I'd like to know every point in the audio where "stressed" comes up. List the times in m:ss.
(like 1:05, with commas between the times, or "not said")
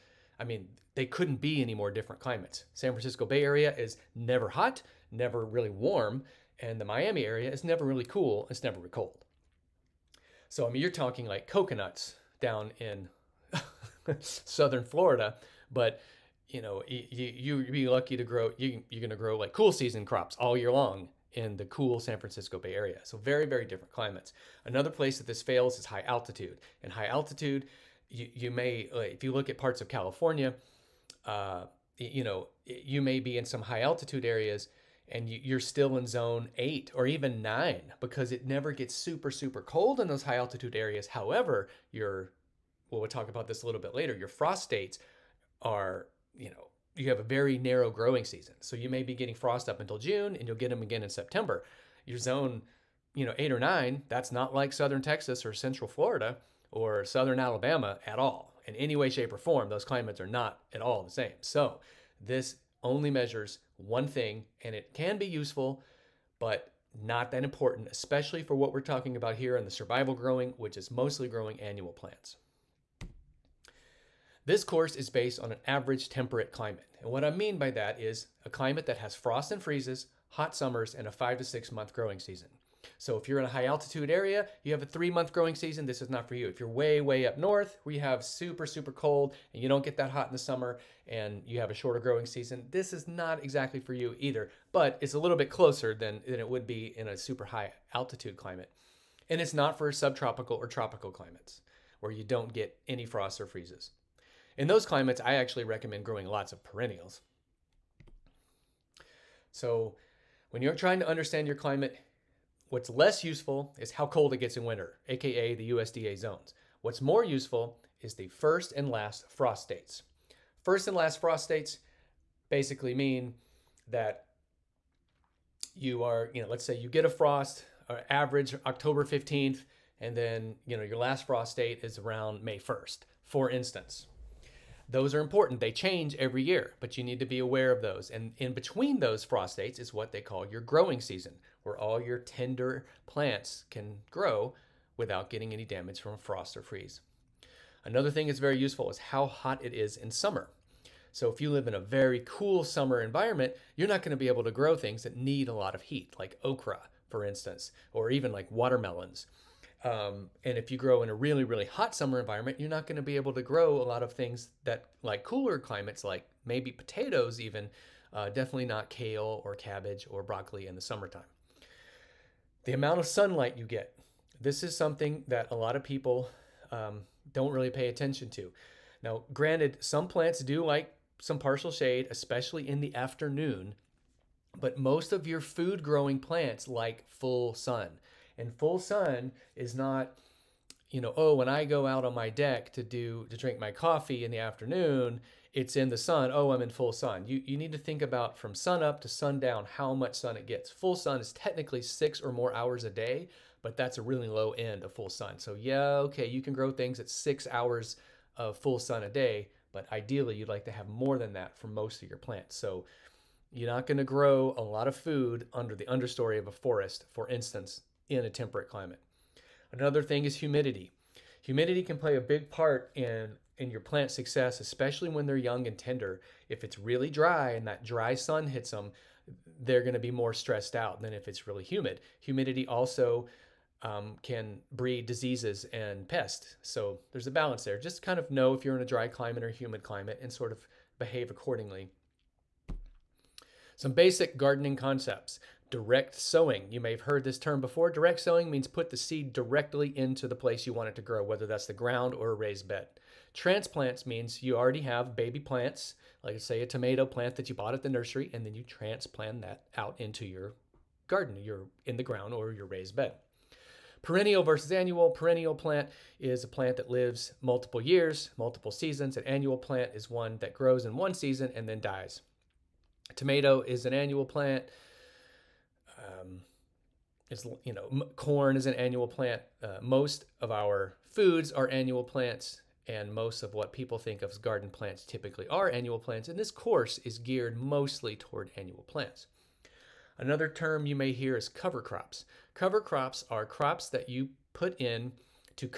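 3:50.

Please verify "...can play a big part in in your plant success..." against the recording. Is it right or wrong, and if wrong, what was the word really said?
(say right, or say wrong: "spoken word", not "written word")
right.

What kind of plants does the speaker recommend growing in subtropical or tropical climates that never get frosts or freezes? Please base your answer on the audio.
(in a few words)
perennials.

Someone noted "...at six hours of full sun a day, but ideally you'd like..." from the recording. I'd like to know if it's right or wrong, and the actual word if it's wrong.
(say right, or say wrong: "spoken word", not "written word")
right.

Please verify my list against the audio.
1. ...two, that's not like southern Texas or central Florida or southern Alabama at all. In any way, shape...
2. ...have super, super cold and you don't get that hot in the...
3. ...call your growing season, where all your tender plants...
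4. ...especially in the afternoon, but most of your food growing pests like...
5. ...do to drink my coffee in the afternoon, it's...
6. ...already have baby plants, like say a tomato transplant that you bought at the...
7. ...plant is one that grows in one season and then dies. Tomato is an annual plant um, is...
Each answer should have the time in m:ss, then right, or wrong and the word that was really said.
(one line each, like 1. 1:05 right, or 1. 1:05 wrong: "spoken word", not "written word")
1. 0:53 wrong: "nine", not "two"
2. 1:27 right
3. 2:20 right
4. 3:02 wrong: "plants", not "pests"
5. 3:12 right
6. 4:14 wrong: "plant", not "transplant"
7. 4:29 right.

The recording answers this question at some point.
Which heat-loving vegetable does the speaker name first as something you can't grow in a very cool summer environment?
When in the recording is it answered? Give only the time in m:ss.
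2:36.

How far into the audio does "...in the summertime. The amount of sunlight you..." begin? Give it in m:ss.
2:50.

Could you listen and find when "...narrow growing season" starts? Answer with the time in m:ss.
0:47.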